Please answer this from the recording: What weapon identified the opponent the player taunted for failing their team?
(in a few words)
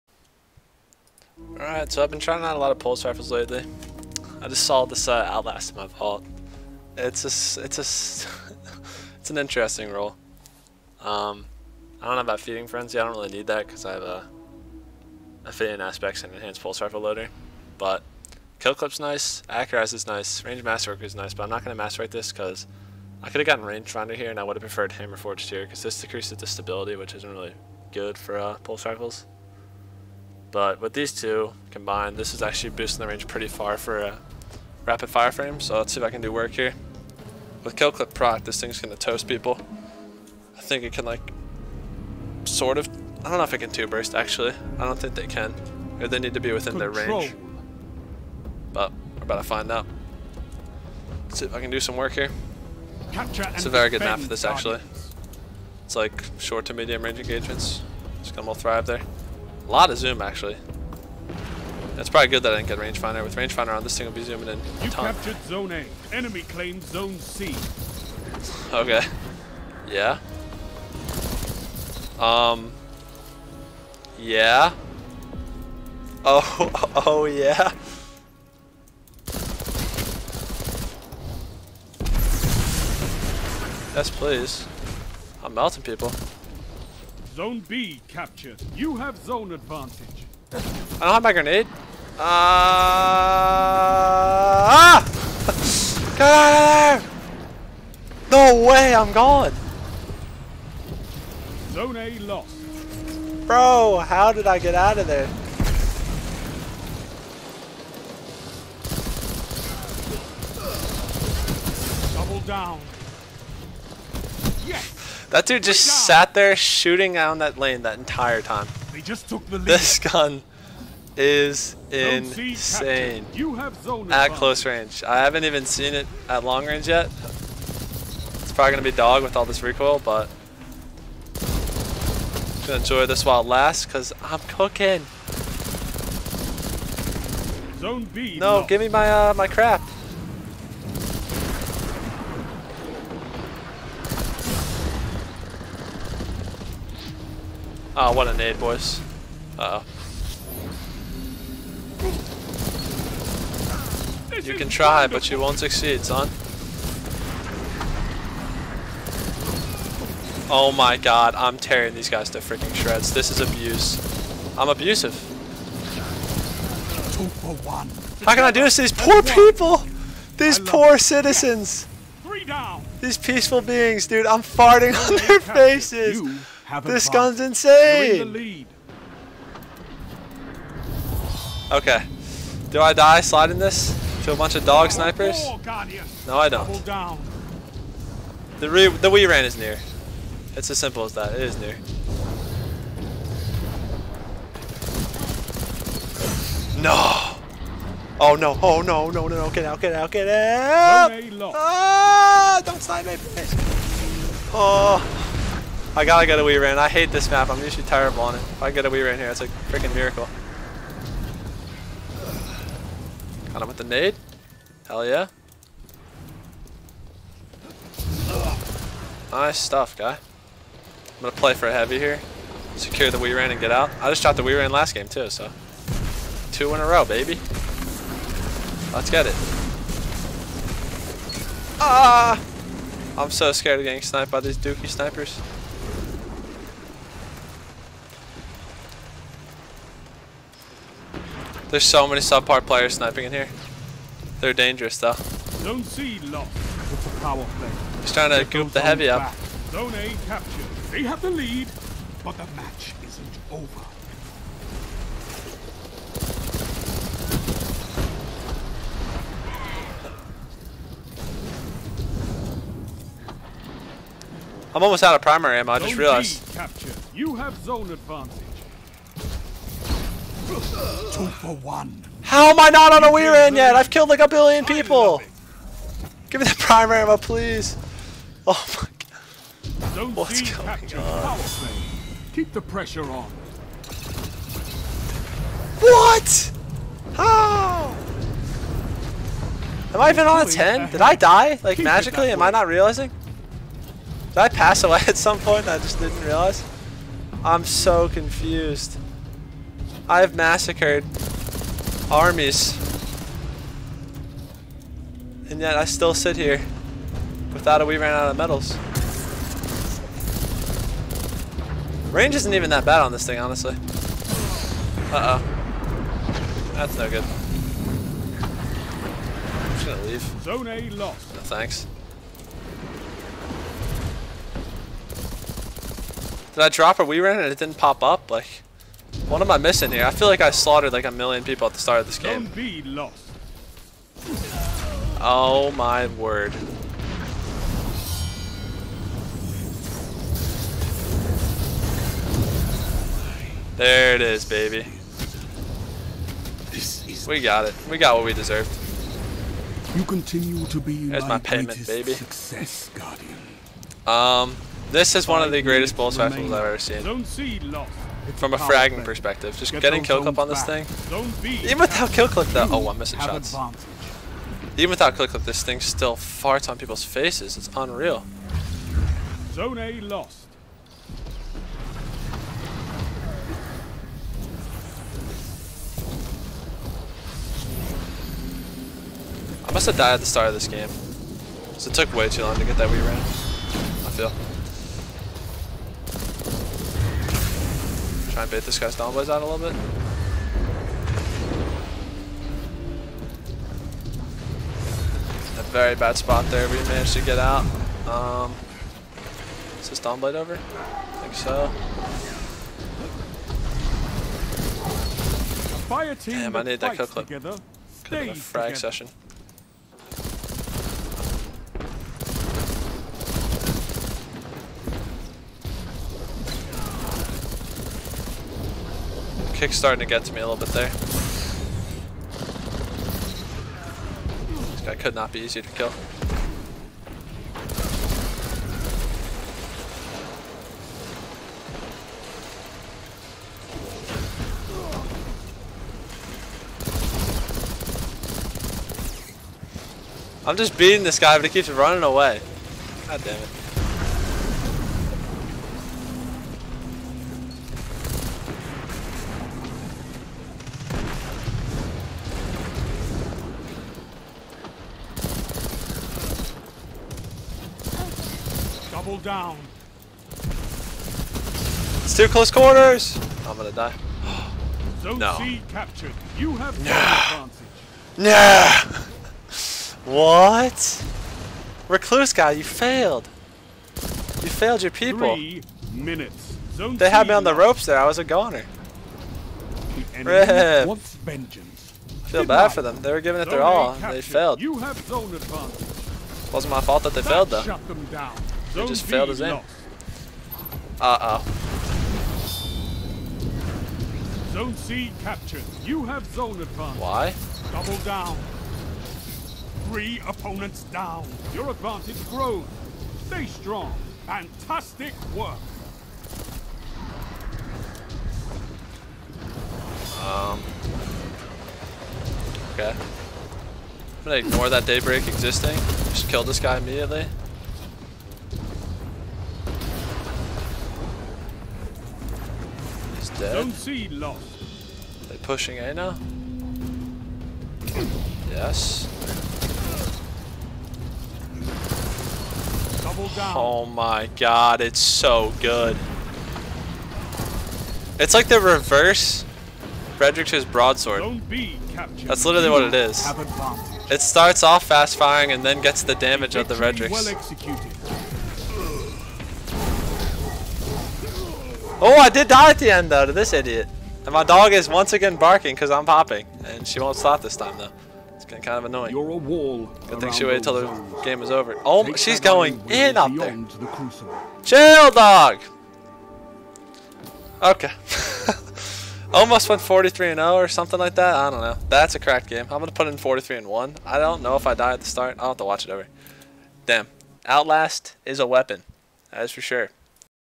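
Recluse.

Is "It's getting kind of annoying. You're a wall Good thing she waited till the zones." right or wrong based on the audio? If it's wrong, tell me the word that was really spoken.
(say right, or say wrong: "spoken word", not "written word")
right.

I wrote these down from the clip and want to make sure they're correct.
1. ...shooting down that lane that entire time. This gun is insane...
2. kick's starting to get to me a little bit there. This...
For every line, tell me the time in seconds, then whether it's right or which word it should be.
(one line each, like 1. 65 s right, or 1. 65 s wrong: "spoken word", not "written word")
1. 116 s right
2. 419 s right.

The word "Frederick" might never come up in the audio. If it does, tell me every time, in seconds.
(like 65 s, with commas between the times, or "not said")
540 s, 546 s.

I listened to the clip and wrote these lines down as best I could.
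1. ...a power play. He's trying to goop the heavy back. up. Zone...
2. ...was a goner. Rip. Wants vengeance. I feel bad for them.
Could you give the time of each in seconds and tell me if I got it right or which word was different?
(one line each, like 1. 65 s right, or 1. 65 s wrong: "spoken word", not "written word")
1. 247 s right
2. 478 s right.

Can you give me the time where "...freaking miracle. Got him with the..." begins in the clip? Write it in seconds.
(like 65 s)
209 s.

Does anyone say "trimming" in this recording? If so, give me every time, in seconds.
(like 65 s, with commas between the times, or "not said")
not said.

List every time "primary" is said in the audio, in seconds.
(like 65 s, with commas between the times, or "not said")
265 s, 276 s.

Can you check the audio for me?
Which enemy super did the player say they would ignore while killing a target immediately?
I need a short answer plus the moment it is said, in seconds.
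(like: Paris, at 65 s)
Daybreak, at 514 s.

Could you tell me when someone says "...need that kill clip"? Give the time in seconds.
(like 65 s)
406 s.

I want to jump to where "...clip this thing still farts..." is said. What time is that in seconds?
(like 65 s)
365 s.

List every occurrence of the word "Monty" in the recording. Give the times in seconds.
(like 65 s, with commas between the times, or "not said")
not said.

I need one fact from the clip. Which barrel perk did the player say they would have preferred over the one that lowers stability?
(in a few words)
Hammer forged.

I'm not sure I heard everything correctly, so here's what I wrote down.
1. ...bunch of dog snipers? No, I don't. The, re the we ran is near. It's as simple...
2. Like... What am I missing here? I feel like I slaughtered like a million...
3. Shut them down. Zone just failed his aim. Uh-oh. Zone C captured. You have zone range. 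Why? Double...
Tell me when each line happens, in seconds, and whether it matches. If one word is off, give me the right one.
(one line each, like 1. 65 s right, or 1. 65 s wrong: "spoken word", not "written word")
1. 184 s right
2. 328 s right
3. 487 s wrong: "advantage", not "range".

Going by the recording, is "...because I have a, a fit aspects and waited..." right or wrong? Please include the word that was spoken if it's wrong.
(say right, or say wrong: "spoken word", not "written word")
wrong: "enhanced", not "waited".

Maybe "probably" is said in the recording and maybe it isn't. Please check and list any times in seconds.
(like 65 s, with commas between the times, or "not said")
62 s, 128 s.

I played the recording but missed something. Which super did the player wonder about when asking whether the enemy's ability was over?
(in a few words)
Dawnblade.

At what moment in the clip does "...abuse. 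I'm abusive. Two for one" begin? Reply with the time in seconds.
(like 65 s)
163 s.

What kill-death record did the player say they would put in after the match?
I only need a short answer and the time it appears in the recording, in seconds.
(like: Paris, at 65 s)
43 and 1, at 573 s.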